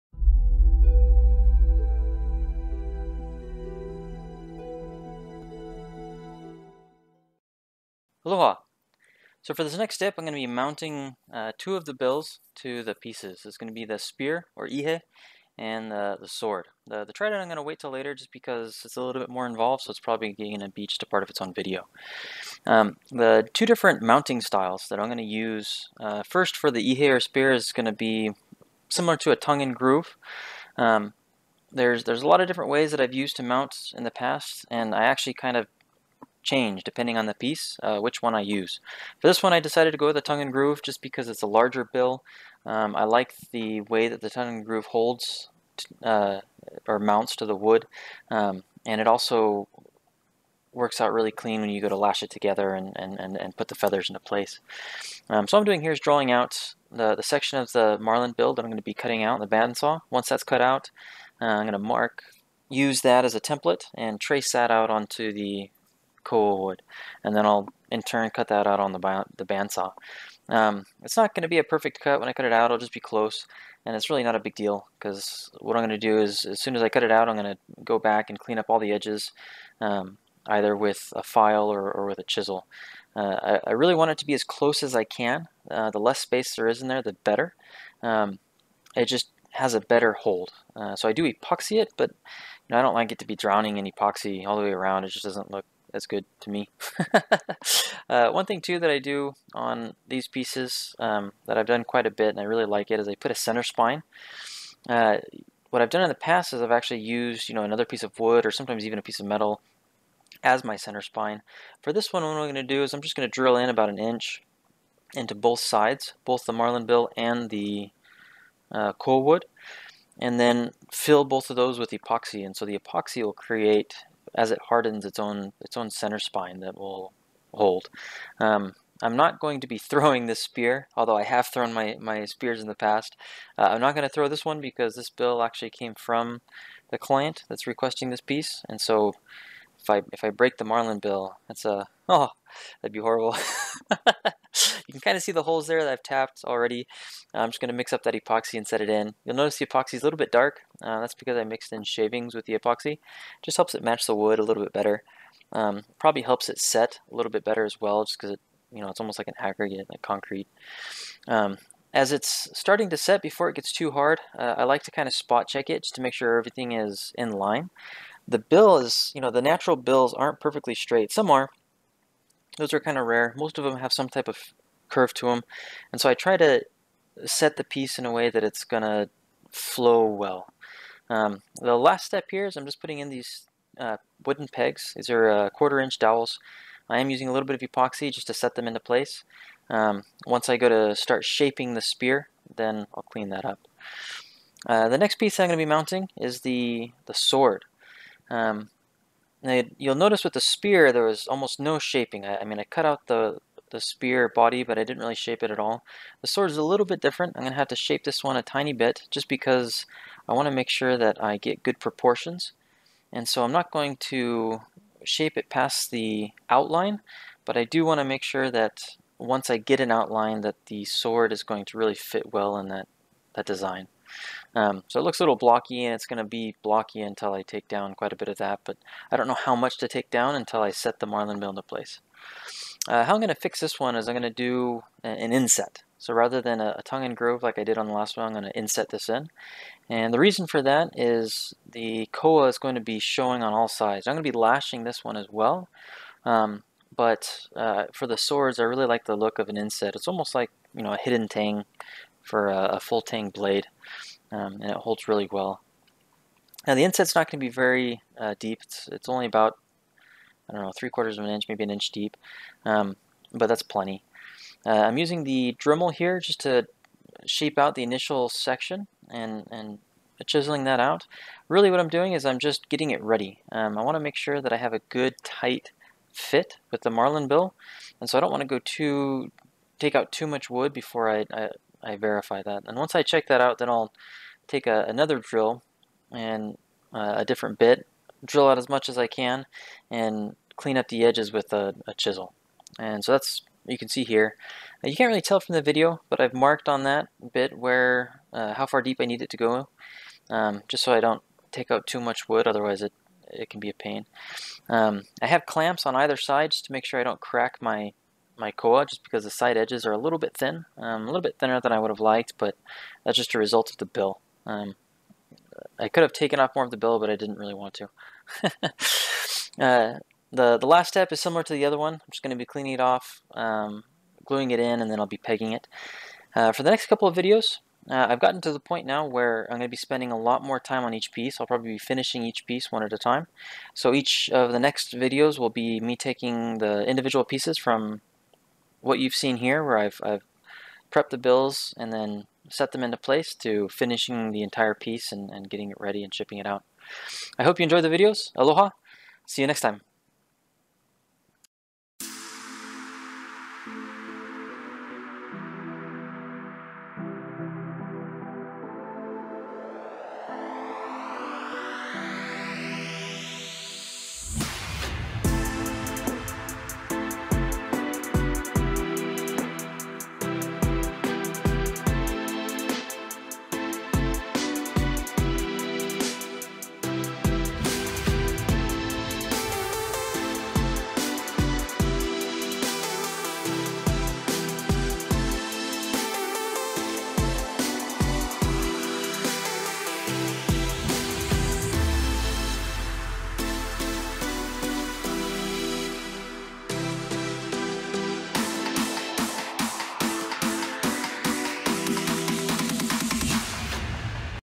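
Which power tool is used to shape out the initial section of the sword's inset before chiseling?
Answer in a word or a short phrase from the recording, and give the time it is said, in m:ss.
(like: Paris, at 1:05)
Dremel, at 4:25.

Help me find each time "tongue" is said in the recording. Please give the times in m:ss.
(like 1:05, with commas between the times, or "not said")
0:29, 0:40, 0:44, 3:56.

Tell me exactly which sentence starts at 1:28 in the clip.
Um, it just has a better hold.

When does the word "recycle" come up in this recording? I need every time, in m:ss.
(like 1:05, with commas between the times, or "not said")
not said.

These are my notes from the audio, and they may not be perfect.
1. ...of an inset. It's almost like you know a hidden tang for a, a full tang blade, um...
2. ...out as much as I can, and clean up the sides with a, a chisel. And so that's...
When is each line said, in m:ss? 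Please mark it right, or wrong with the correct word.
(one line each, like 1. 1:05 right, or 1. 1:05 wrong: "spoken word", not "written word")
1. 4:09 right
2. 4:48 wrong: "edges", not "sides".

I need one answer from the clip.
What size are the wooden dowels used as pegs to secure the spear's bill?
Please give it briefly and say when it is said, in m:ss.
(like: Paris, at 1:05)
Quarter inch, at 3:05.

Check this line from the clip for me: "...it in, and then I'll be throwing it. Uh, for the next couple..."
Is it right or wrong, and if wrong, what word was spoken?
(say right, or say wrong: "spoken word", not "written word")
wrong: "pegging", not "throwing".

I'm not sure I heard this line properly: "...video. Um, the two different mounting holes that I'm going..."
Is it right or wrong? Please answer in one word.
wrong.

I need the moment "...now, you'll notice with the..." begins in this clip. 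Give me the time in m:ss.
3:19.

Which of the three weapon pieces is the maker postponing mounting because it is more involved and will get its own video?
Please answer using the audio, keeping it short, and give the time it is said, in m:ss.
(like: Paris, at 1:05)
Trident, at 0:17.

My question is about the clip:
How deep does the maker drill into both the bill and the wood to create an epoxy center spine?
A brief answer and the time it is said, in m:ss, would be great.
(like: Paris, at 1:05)
About an inch, at 1:53.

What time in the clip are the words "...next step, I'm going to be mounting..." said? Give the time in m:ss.
0:09.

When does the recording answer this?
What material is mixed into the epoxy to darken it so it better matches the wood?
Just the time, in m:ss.
2:31.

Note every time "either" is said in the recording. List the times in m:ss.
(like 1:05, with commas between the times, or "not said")
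1:20, 5:05.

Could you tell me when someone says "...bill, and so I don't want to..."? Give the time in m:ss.
4:37.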